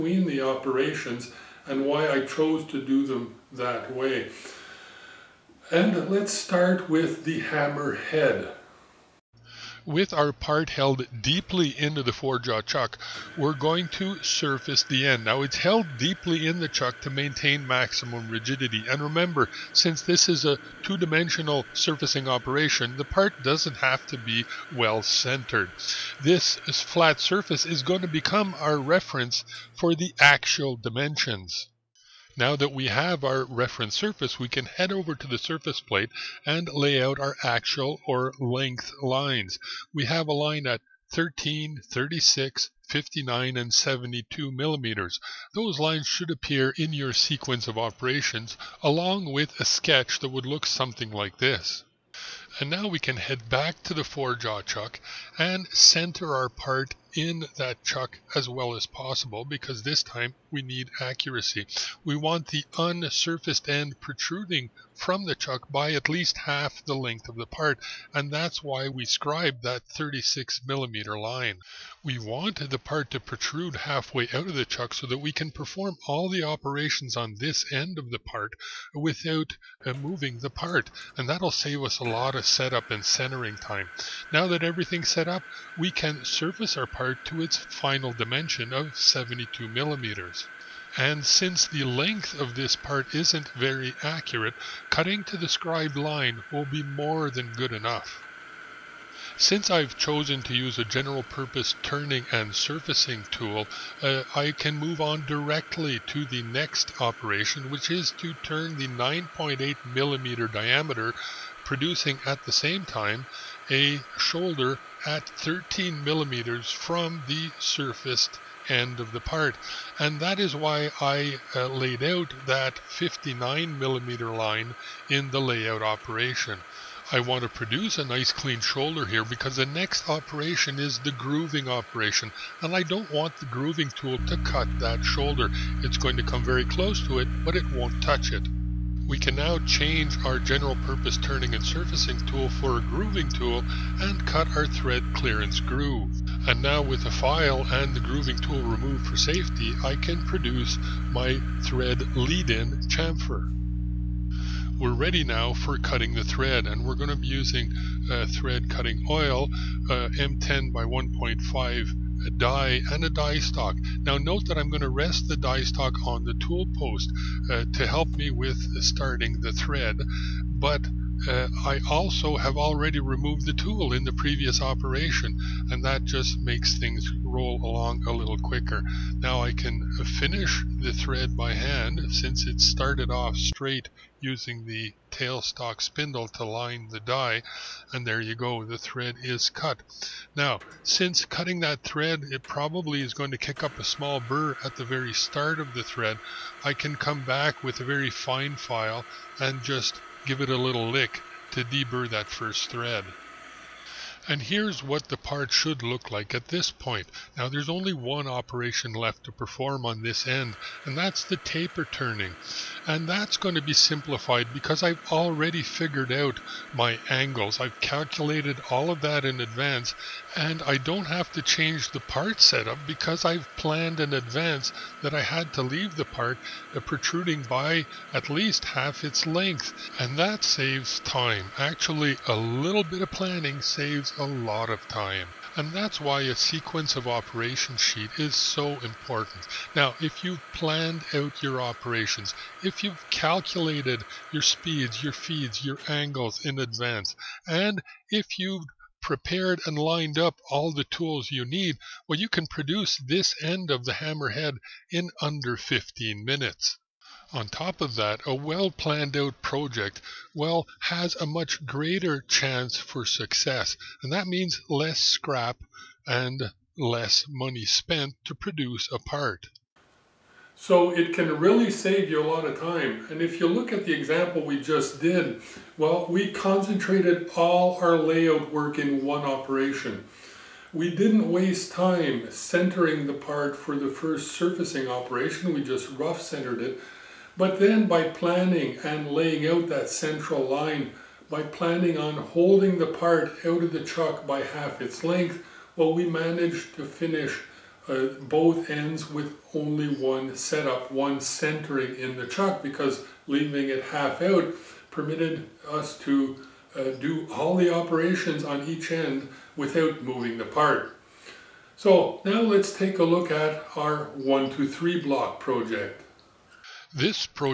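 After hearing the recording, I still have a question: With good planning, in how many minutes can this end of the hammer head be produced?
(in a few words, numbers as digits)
under 15 minutes.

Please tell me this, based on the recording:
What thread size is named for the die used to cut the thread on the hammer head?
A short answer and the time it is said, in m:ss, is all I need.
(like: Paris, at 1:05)
M10 by 1.5, at 2:40.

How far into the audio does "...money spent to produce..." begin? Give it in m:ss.
4:27.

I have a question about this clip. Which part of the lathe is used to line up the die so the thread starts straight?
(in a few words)
tailstock spindle.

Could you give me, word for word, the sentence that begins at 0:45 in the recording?
Those lines should appear in your sequence of operations along with a sketch that would look something like this.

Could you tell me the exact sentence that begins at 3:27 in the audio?
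Now there's only one operation left to perform on this end, and that's the taper turning.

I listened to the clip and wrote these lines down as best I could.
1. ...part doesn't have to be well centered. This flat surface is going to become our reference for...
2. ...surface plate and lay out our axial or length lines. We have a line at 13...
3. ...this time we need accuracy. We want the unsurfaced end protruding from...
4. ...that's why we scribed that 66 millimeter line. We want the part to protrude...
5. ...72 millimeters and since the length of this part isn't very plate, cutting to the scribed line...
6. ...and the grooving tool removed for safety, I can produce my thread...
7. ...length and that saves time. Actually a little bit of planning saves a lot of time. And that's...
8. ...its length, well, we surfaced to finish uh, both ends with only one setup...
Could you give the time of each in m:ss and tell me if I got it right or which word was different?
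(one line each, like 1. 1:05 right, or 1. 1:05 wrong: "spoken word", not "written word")
1. 0:23 right
2. 0:35 right
3. 0:59 right
4. 1:08 wrong: "36", not "66"
5. 1:28 wrong: "accurate", not "plate"
6. 2:27 right
7. 3:49 right
8. 4:54 wrong: "managed", not "surfaced".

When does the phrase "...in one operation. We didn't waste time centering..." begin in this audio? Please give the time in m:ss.
4:38.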